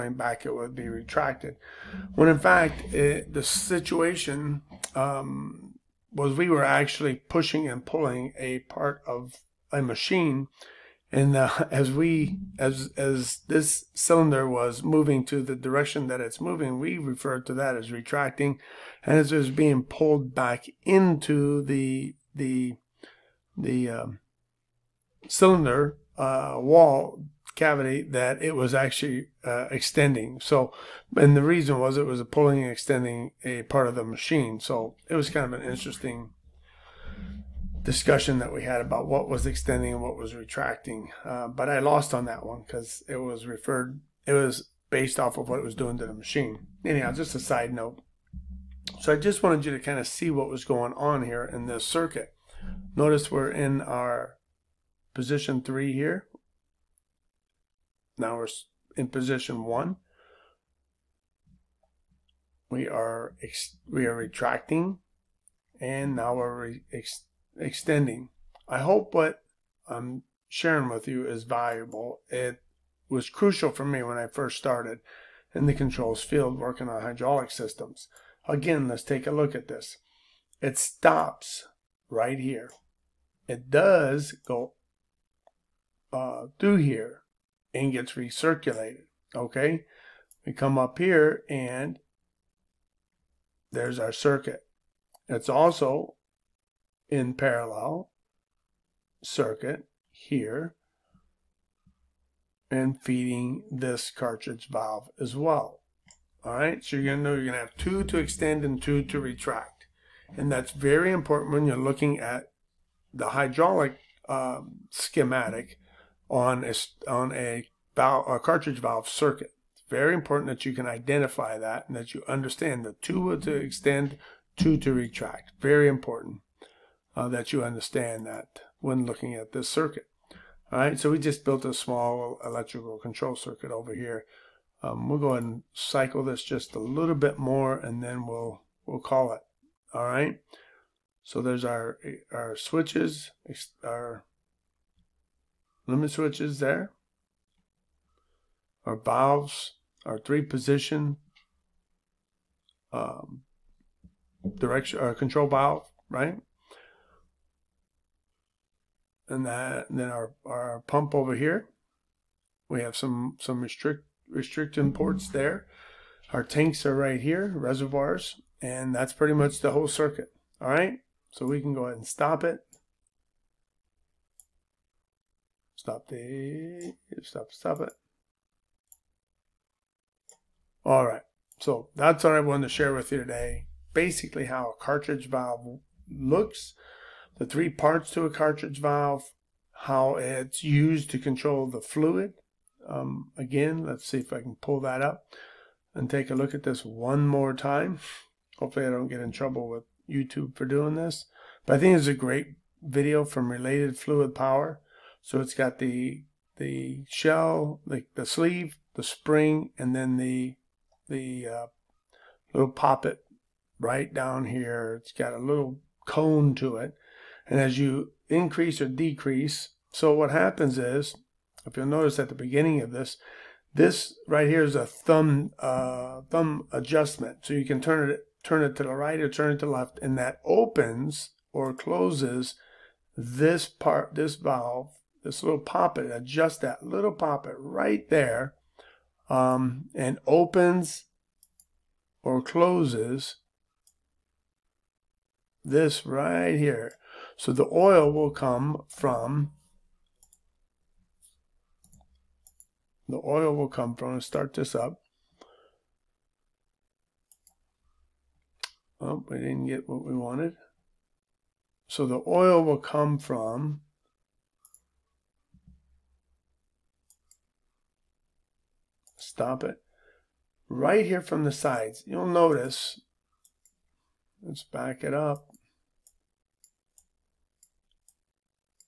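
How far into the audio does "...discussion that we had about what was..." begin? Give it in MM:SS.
00:37.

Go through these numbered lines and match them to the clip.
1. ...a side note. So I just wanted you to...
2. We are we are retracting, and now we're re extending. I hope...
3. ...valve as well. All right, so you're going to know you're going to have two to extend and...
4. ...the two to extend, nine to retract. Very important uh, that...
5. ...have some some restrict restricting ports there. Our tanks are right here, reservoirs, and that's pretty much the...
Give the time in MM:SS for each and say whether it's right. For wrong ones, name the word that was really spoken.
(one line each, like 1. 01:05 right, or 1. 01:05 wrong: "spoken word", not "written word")
1. 00:47 right
2. 01:02 right
3. 01:44 right
4. 02:02 wrong: "two", not "nine"
5. 02:42 right.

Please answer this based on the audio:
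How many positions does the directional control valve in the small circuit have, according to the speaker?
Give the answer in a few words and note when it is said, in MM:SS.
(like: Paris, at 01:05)
3, at 02:30.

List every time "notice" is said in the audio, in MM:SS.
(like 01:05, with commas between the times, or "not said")
00:52, 03:41, 04:32.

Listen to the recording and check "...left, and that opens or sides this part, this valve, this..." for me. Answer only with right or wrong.
wrong.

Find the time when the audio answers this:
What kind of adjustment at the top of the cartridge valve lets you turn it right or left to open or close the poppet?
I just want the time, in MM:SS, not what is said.
03:46.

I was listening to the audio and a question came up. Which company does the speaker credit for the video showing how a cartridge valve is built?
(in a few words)
Related Fluid Power.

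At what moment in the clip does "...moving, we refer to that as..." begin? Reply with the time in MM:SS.
00:16.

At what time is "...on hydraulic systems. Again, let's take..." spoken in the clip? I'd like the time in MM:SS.
01:16.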